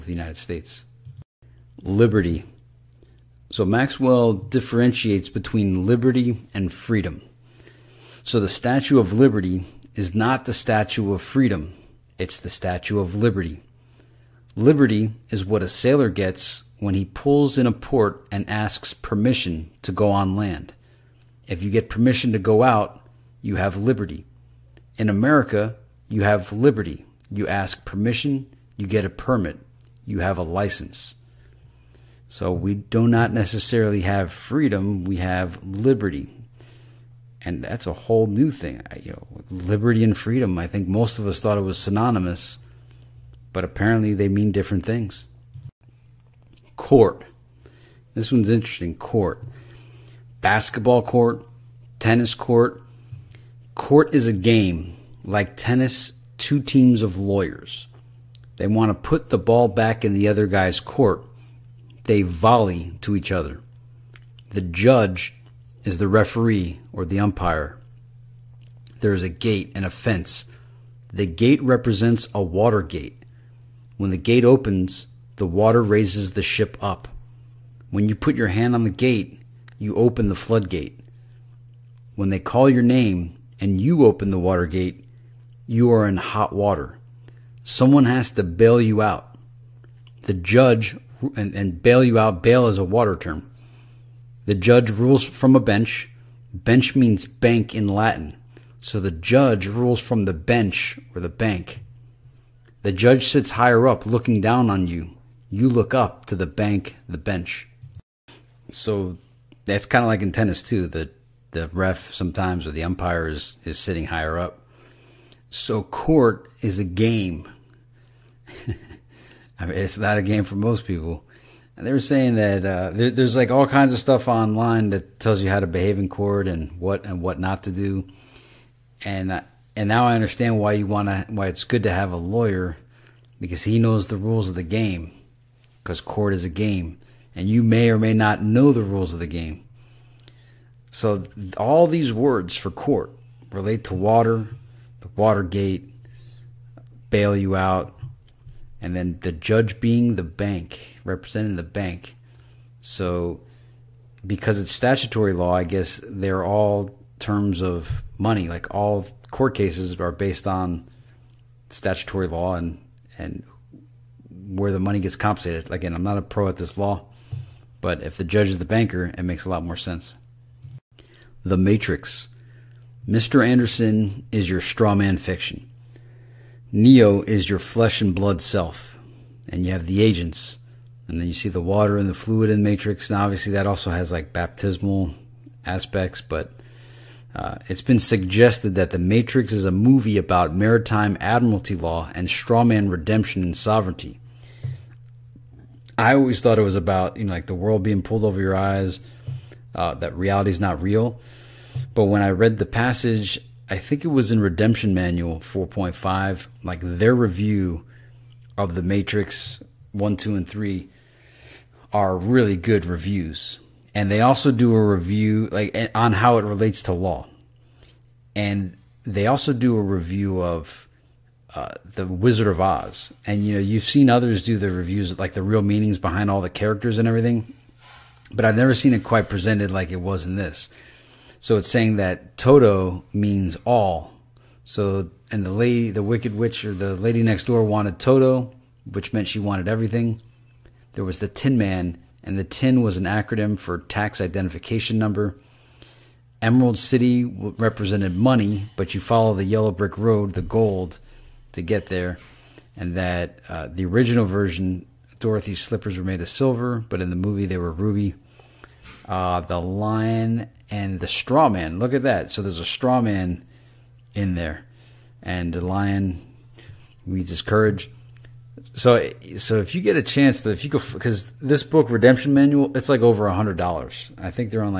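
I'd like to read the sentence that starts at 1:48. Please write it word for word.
So that's kind of like in tennis too.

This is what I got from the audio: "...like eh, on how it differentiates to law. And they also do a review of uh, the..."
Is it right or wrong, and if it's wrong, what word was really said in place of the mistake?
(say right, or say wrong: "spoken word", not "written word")
wrong: "relates", not "differentiates".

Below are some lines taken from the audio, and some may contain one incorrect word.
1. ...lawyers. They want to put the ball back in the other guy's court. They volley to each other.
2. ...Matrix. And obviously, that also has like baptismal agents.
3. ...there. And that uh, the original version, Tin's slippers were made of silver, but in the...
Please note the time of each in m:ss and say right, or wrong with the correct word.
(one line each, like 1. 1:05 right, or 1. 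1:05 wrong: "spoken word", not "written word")
1. 0:57 right
2. 3:02 wrong: "aspects", not "agents"
3. 4:11 wrong: "Dorothy", not "Tin".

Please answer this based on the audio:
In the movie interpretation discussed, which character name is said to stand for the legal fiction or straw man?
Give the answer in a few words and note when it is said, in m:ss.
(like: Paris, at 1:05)
Mr. Anderson, at 2:53.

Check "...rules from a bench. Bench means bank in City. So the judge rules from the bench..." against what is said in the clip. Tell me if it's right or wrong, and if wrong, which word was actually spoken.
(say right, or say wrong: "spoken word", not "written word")
wrong: "Latin", not "City".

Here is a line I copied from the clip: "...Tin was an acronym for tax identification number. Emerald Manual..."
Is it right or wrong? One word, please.
wrong.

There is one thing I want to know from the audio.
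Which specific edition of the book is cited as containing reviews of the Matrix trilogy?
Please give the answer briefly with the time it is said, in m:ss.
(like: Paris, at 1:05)
Redemption Manual 4.5, at 3:24.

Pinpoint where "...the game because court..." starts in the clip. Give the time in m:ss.
2:14.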